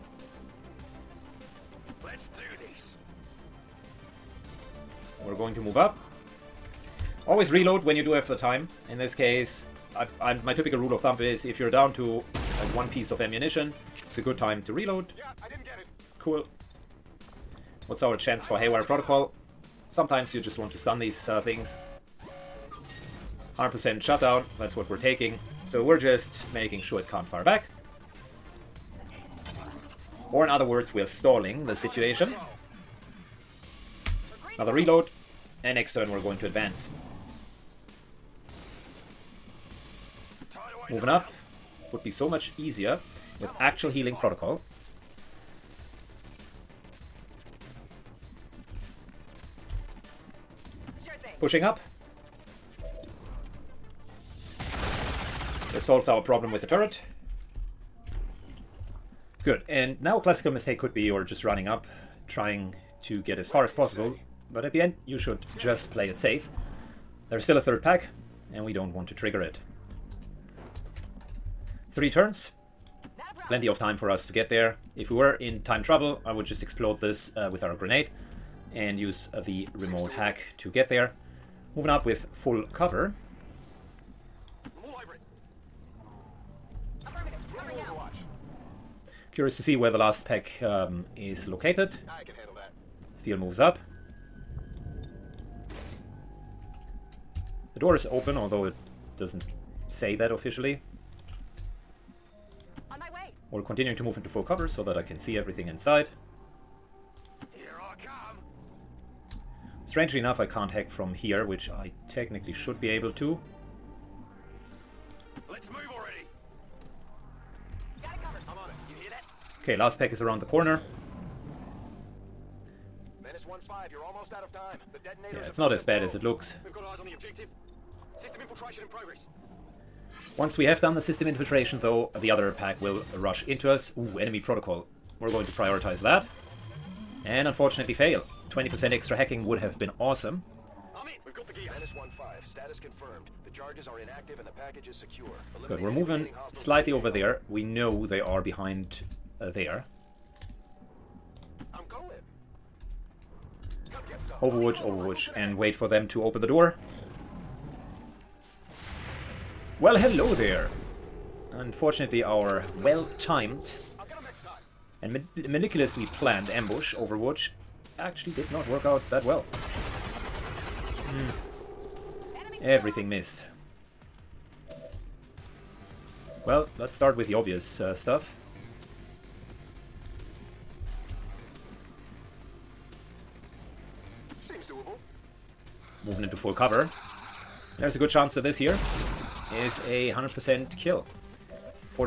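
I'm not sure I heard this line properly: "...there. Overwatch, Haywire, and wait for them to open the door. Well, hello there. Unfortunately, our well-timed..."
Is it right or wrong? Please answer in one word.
wrong.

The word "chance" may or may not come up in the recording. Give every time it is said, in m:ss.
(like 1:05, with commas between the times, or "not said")
0:18, 3:08.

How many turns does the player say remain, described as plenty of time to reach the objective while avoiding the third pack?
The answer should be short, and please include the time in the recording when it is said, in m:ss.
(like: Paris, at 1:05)
3, at 1:11.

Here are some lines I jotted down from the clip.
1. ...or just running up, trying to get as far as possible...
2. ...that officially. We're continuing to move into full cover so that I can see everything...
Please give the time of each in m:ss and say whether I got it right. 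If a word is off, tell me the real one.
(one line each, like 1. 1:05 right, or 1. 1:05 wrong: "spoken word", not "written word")
1. 1:01 right
2. 1:40 right.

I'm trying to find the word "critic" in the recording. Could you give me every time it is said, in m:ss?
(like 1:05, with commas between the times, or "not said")
not said.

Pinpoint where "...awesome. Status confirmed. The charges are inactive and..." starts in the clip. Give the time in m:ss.
2:19.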